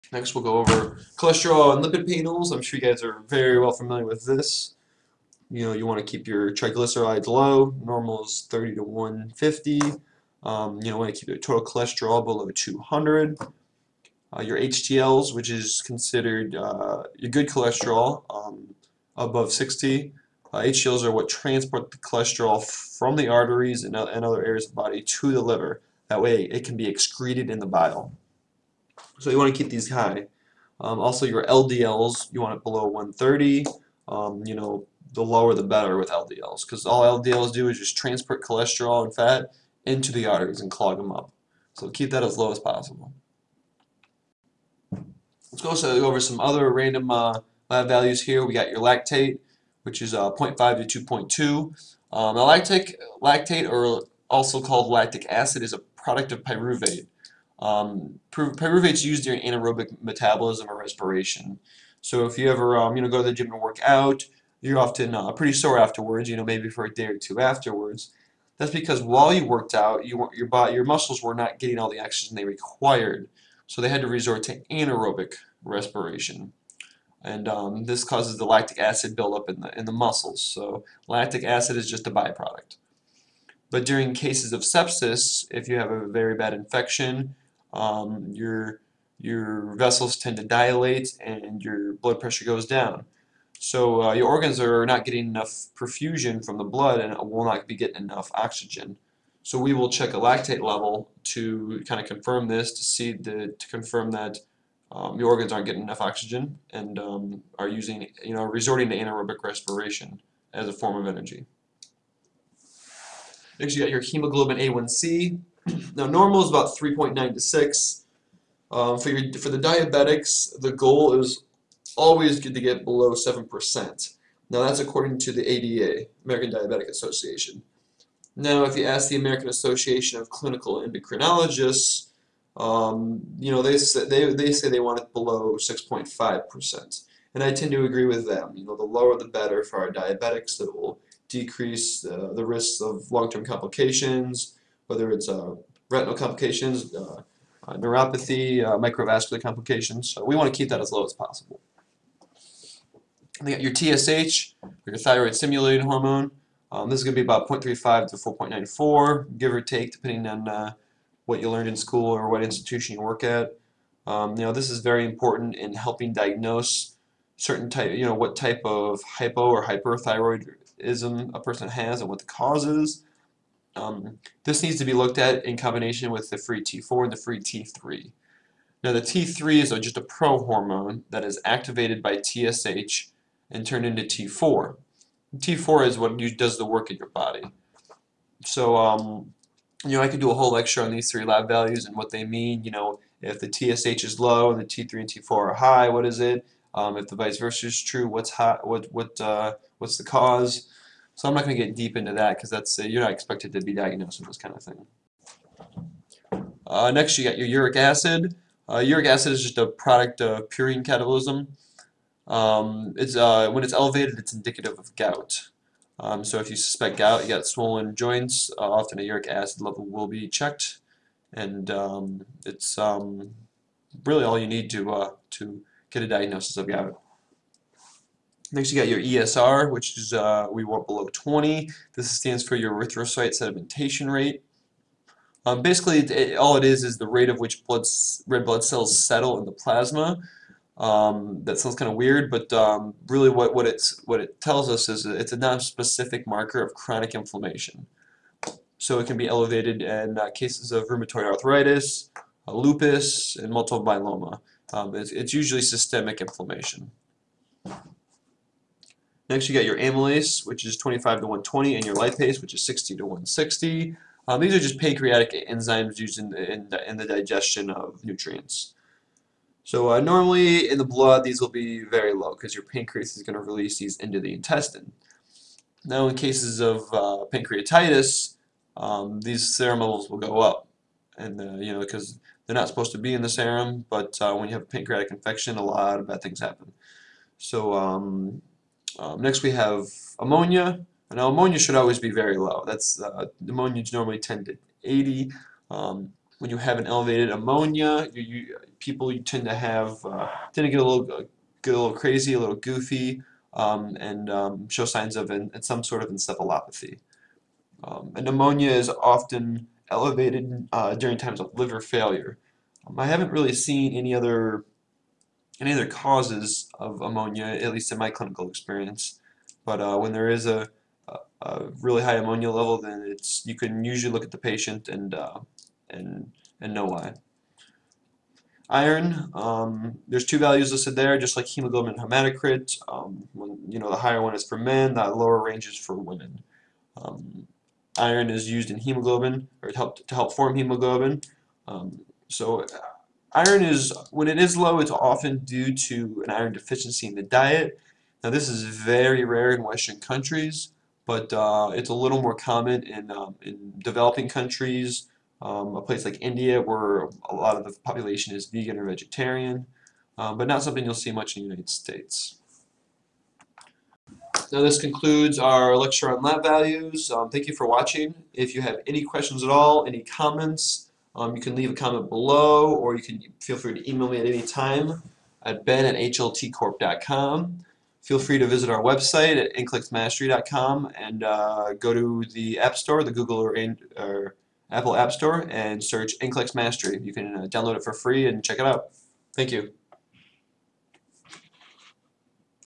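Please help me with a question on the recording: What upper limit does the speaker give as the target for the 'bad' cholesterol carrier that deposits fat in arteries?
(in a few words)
130.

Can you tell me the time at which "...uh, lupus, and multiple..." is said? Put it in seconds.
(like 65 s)
252 s.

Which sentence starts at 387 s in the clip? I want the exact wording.
You can uh, download it for free and check it out.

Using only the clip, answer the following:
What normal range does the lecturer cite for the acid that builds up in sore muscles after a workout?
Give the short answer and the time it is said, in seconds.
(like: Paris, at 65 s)
0.5 to 2.2, at 50 s.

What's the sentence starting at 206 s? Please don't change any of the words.
Uh, next, you got your uric acid.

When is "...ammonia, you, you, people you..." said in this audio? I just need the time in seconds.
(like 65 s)
297 s.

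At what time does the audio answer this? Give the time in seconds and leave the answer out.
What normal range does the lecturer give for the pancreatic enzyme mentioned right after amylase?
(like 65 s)
262 s.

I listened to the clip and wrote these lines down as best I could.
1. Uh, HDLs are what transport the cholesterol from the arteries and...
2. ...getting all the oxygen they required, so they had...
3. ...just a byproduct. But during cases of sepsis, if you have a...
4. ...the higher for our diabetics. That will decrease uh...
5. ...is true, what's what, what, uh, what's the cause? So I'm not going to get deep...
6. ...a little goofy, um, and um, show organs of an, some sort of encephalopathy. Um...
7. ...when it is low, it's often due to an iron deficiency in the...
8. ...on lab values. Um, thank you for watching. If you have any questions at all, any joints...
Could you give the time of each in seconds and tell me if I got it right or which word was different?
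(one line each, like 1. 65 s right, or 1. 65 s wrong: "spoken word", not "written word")
1. 20 s right
2. 71 s right
3. 81 s right
4. 139 s wrong: "better", not "higher"
5. 197 s right
6. 302 s wrong: "signs", not "organs"
7. 344 s right
8. 366 s wrong: "comments", not "joints".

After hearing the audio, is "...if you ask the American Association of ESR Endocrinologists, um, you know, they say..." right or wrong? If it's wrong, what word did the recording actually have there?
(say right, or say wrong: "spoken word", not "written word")
wrong: "Clinical", not "ESR".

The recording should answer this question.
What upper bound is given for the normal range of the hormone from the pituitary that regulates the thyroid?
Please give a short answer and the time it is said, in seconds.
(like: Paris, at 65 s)
4.94, at 158 s.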